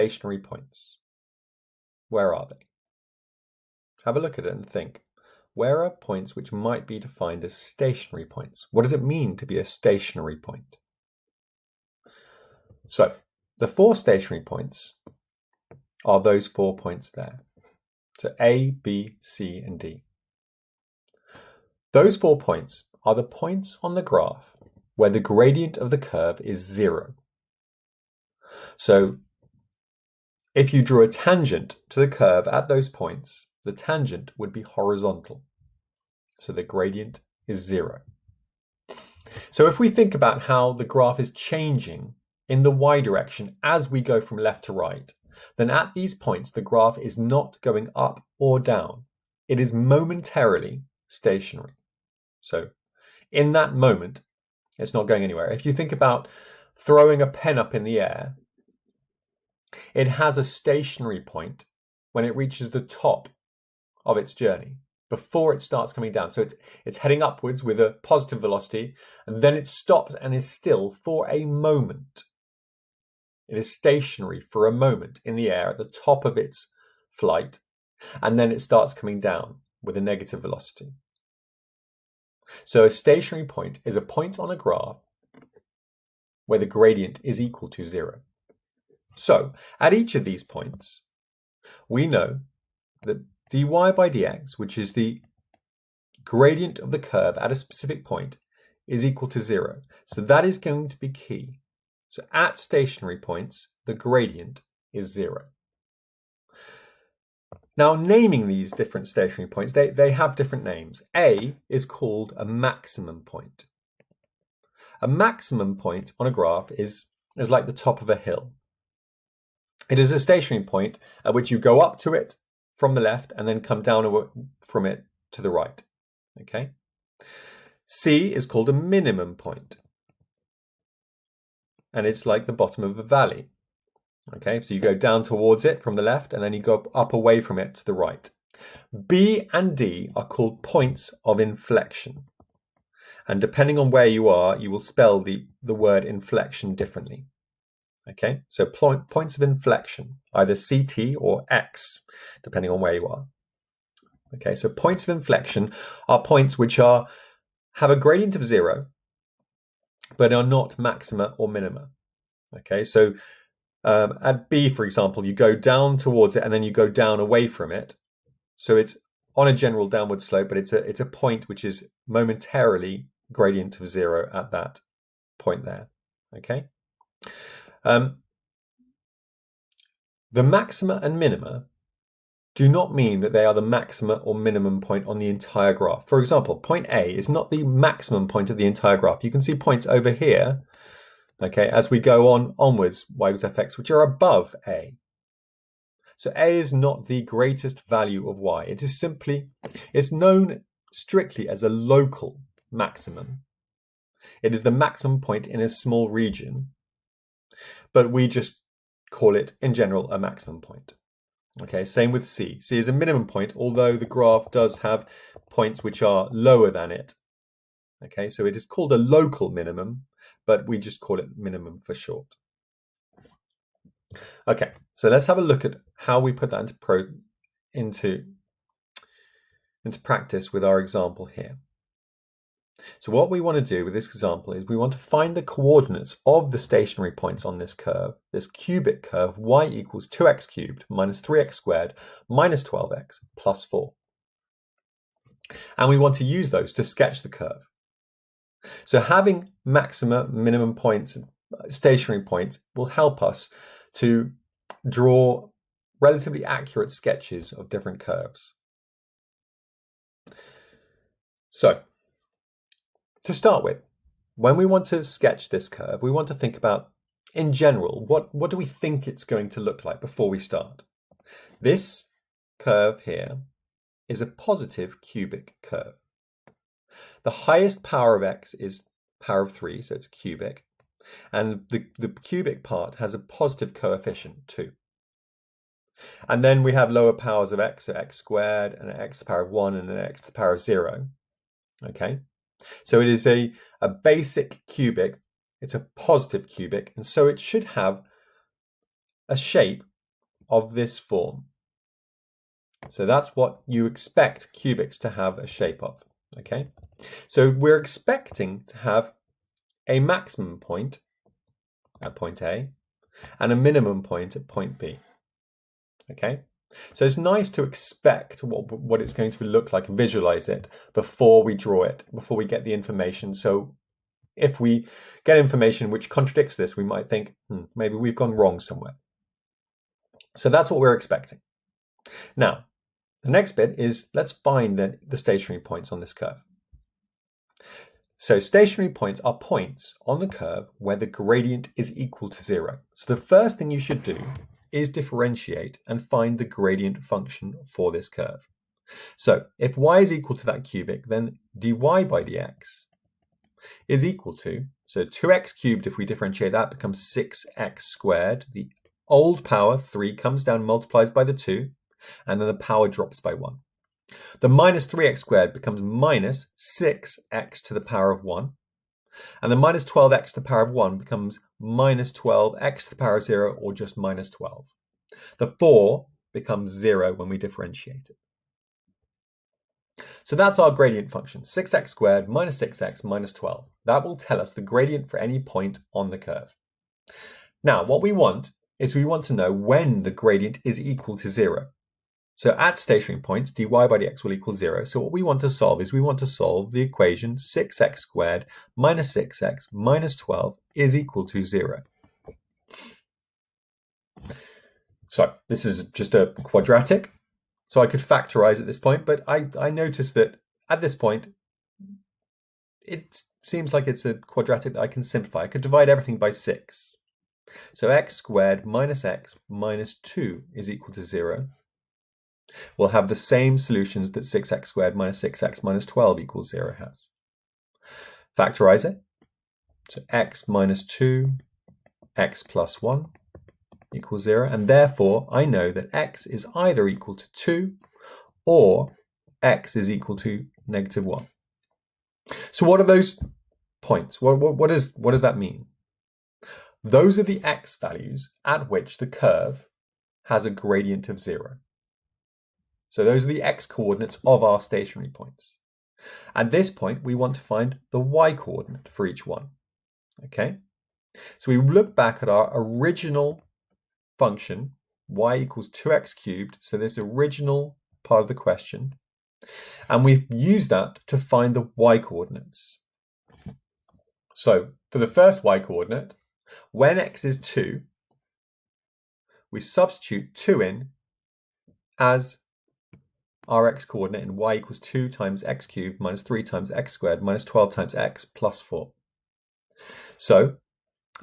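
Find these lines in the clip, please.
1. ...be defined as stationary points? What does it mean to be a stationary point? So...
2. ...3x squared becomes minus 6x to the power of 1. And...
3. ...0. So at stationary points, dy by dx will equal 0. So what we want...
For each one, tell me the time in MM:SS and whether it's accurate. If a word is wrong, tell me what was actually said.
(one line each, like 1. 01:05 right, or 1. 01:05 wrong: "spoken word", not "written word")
1. 00:06 right
2. 06:04 right
3. 06:31 right.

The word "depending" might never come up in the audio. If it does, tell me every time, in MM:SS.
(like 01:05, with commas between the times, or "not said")
02:23, 02:32.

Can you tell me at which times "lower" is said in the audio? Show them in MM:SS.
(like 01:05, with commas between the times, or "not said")
03:36, 04:46.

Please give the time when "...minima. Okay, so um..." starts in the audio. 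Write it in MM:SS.
02:41.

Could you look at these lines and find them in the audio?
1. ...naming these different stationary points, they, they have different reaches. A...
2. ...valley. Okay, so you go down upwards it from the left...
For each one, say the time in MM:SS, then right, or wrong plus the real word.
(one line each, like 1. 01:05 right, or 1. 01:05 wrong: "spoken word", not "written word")
1. 01:47 wrong: "names", not "reaches"
2. 02:13 wrong: "towards", not "upwards".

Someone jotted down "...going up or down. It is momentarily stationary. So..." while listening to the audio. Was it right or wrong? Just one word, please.
right.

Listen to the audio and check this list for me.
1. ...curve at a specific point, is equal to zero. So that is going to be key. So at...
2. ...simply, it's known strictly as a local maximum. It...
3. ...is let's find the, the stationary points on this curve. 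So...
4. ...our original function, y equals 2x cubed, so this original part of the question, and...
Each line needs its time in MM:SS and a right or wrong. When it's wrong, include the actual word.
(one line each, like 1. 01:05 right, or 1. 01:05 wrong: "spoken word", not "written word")
1. 01:36 right
2. 03:18 right
3. 05:33 right
4. 07:42 right.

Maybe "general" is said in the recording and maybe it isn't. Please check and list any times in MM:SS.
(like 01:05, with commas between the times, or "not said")
02:49, 03:29, 04:27.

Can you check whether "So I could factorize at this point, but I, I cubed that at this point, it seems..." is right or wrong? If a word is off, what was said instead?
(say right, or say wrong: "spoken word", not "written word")
wrong: "noticed", not "cubed".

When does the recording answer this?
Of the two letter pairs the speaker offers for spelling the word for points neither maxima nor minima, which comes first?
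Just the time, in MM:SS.
02:30.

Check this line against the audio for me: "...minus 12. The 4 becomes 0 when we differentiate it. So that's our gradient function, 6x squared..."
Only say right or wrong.
right.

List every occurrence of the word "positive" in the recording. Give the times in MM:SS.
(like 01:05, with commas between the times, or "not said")
01:08, 04:34, 04:43, 04:55.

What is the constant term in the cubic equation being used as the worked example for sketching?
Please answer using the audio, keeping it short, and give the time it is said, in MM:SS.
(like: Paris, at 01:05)
4, at 04:02.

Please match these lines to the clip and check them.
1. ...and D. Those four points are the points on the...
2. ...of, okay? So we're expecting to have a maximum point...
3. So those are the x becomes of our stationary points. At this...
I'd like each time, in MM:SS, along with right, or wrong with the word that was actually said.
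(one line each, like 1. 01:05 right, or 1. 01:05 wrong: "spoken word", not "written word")
1. 00:19 right
2. 05:05 right
3. 07:32 wrong: "coordinates", not "becomes".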